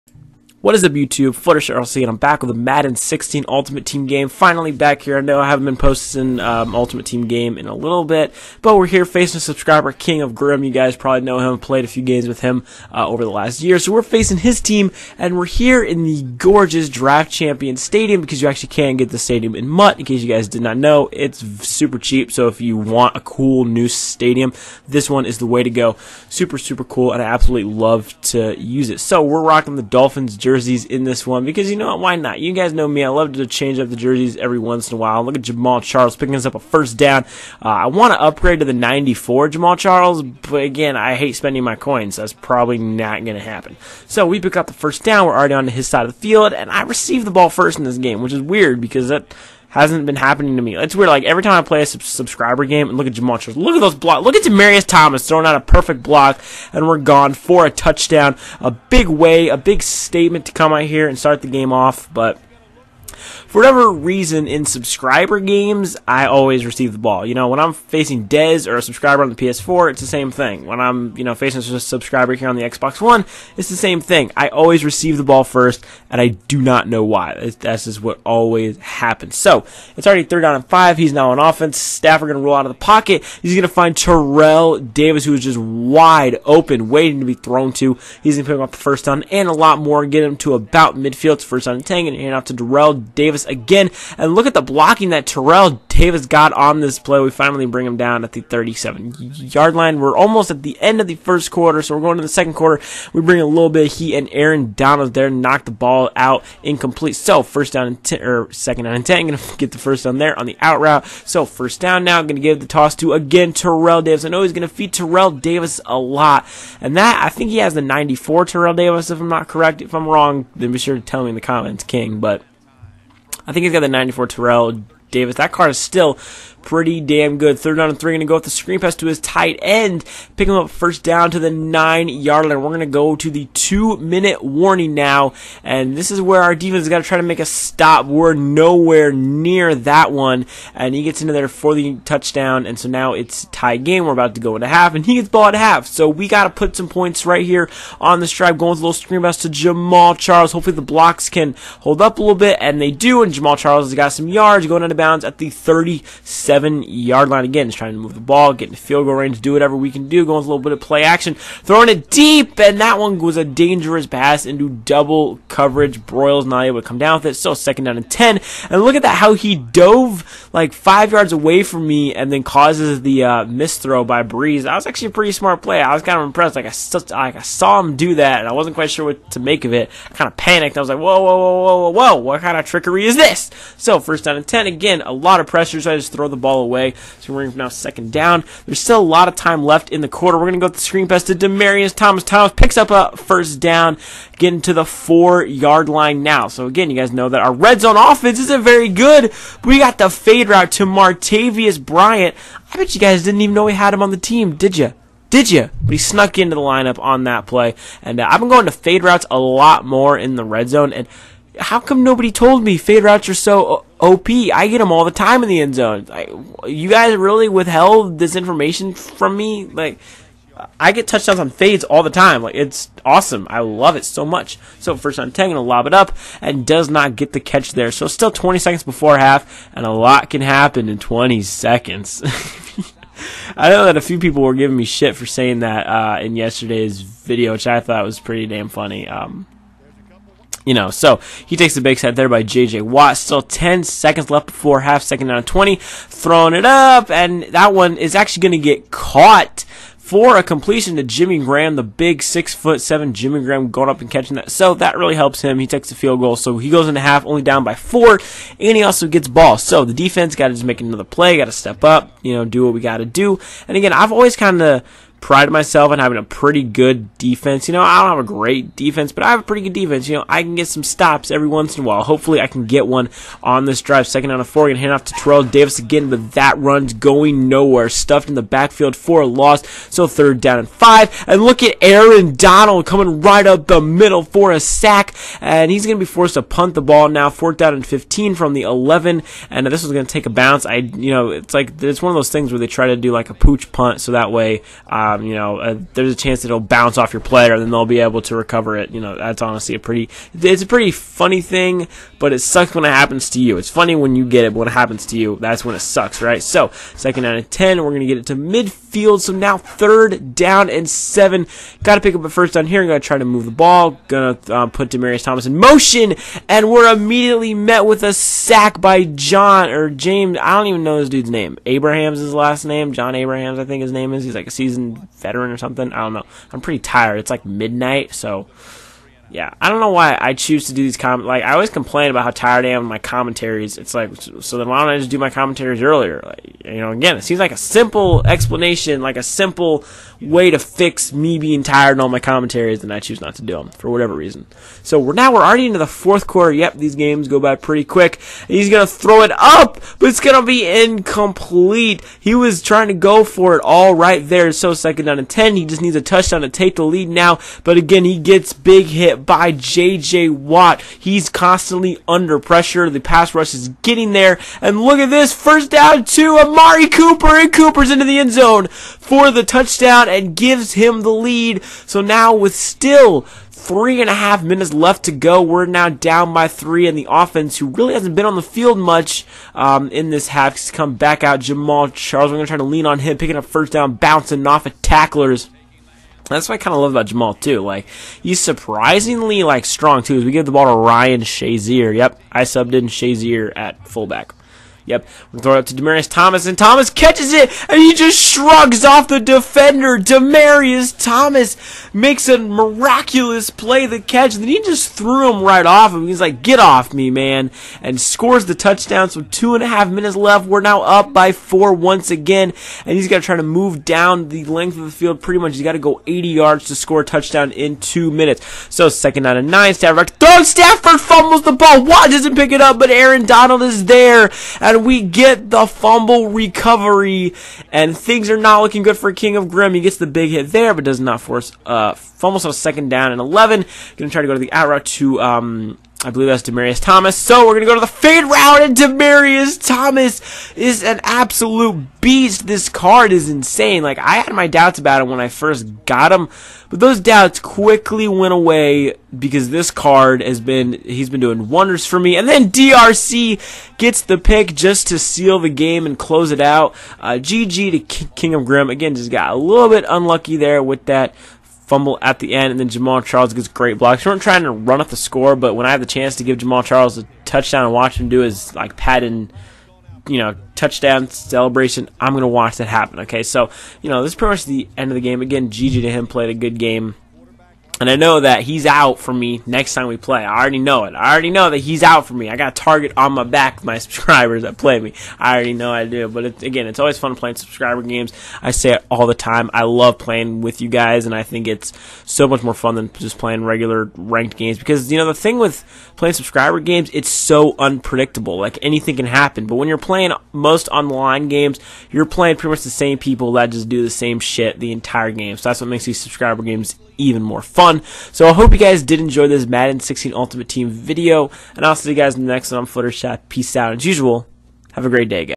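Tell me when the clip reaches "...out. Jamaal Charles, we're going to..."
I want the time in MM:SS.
06:21.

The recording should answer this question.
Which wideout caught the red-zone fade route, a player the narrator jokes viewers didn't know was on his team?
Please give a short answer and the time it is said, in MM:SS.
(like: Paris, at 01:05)
Martavis Bryant, at 03:20.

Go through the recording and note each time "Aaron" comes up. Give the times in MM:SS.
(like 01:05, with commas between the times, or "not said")
01:44, 04:41, 07:02.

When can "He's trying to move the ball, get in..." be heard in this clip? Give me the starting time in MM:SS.
02:37.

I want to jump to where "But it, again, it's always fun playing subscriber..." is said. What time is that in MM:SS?
08:06.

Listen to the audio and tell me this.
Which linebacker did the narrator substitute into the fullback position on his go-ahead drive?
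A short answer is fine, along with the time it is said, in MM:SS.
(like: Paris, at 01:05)
Ryan Shazier, at 06:30.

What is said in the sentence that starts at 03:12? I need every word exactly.
Thomas picks up a first down, getting to the four yard line now.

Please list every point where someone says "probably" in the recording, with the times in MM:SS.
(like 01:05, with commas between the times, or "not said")
00:10, 00:42.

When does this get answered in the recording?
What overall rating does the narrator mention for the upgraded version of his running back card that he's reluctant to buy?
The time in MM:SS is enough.
00:38.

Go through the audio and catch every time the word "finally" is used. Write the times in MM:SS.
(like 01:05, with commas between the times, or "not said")
00:04, 01:37.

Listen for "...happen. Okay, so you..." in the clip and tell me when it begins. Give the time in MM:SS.
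07:52.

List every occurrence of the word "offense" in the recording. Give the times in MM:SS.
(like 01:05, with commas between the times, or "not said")
01:21, 03:17, 06:17.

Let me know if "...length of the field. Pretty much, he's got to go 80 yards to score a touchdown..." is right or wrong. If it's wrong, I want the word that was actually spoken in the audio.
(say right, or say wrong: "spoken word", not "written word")
right.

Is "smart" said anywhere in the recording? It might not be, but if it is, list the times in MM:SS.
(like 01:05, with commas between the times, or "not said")
02:55.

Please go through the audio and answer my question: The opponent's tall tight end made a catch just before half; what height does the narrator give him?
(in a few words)
6 foot 7.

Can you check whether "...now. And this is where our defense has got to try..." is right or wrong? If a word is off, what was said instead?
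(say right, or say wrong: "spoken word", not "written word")
right.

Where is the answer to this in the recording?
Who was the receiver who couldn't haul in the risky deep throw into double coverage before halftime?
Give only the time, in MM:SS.
02:46.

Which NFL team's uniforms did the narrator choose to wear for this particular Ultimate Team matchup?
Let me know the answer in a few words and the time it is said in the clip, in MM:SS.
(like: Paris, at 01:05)
Dolphins, at 00:29.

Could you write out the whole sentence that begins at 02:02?
But I think he's got the 94 Terrell Davis.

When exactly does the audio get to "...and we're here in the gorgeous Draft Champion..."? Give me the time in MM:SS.
00:15.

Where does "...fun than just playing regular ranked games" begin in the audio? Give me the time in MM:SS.
08:12.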